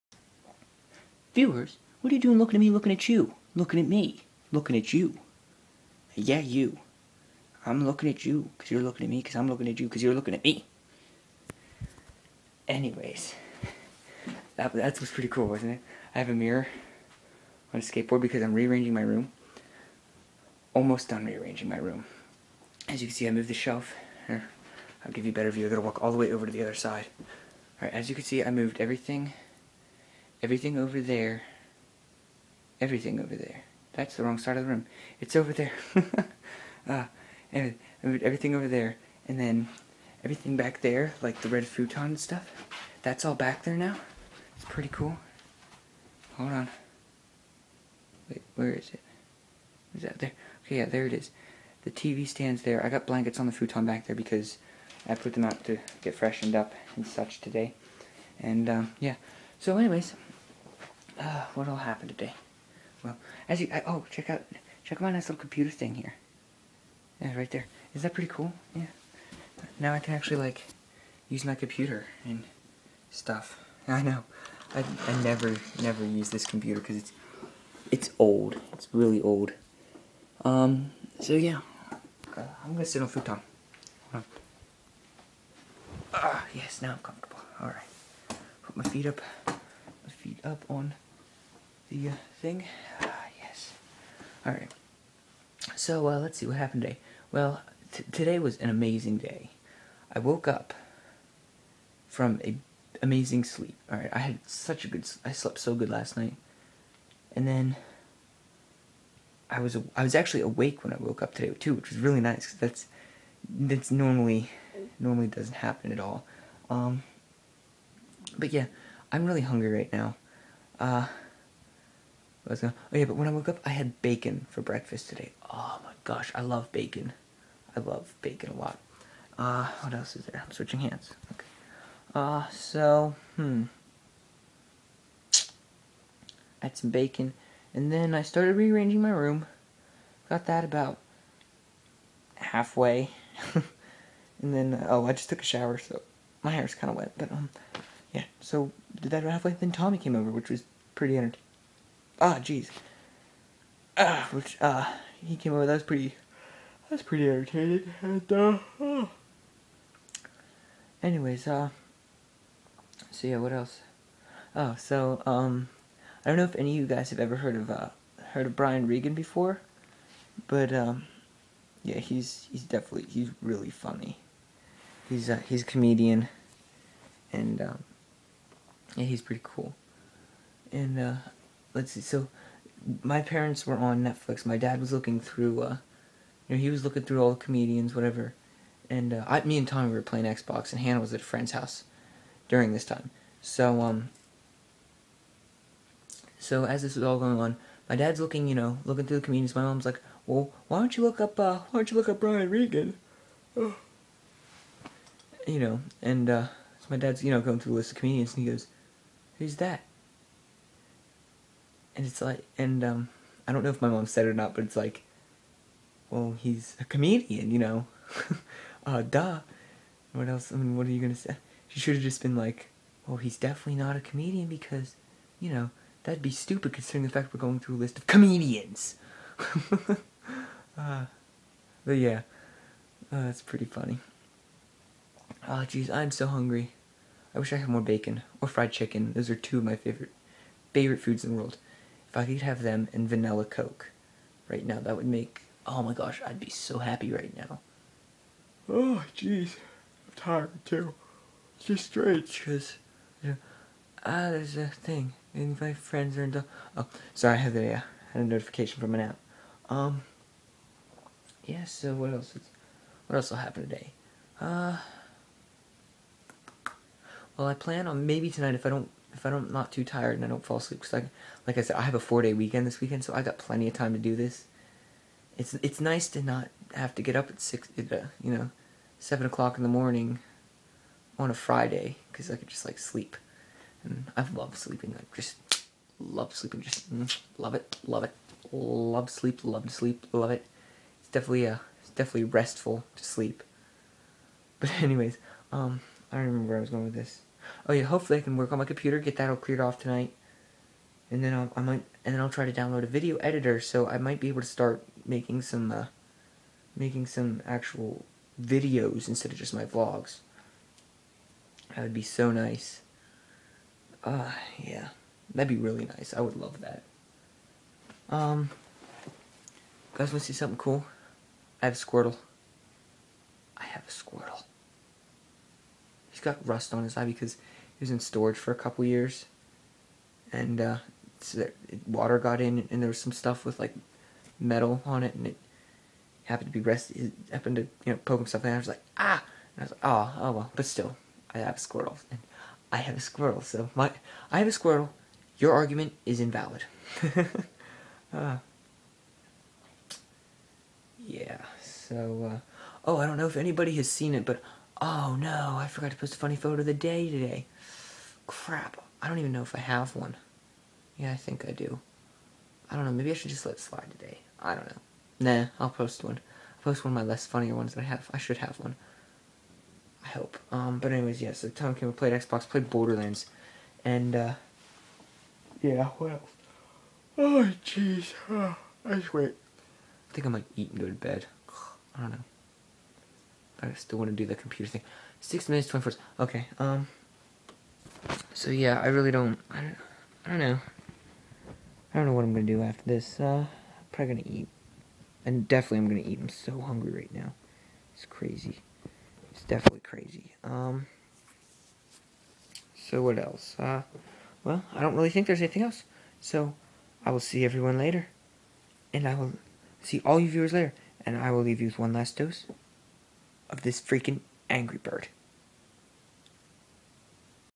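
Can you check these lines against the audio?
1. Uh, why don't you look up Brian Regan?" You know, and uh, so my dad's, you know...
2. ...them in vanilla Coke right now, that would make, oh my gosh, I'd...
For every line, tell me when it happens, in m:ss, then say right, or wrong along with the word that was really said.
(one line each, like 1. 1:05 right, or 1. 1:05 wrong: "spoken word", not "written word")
1. 3:21 right
2. 4:02 right.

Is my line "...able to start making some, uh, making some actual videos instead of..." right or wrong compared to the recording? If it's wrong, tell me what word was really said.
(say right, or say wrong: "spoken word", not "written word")
right.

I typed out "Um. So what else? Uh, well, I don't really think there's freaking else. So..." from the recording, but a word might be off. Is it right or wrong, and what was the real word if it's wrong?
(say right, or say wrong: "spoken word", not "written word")
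wrong: "anything", not "freaking".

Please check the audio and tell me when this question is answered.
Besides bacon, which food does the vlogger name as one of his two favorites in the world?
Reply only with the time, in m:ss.
3:58.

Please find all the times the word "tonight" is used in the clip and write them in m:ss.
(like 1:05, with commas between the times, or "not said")
4:28, 4:59.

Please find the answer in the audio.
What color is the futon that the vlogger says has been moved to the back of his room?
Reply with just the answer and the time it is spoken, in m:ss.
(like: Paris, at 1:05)
red, at 0:41.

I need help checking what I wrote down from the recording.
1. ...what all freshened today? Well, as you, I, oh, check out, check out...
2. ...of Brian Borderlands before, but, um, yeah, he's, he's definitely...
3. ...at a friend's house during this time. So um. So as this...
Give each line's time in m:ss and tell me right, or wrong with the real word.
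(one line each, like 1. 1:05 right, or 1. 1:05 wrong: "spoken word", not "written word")
1. 1:01 wrong: "happened", not "freshened"
2. 2:48 wrong: "Regan", not "Borderlands"
3. 3:11 right.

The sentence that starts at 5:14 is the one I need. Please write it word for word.
Ah, uh, yeah, that'd be really nice.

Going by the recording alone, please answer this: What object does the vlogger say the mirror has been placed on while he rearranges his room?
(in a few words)
skateboard.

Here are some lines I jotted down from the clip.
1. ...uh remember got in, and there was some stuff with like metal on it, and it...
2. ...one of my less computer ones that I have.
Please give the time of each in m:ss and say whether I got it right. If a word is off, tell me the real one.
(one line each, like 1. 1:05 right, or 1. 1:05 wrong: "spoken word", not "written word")
1. 5:31 wrong: "water", not "remember"
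2. 6:06 wrong: "funnier", not "computer".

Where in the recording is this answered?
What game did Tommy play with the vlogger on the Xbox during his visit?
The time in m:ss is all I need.
6:12.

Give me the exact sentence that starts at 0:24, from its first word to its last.
Here, I'll give you a better view.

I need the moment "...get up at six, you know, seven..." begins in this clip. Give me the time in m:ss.
4:37.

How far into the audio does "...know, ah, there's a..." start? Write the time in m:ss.
4:13.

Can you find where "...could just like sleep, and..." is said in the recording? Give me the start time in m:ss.
4:42.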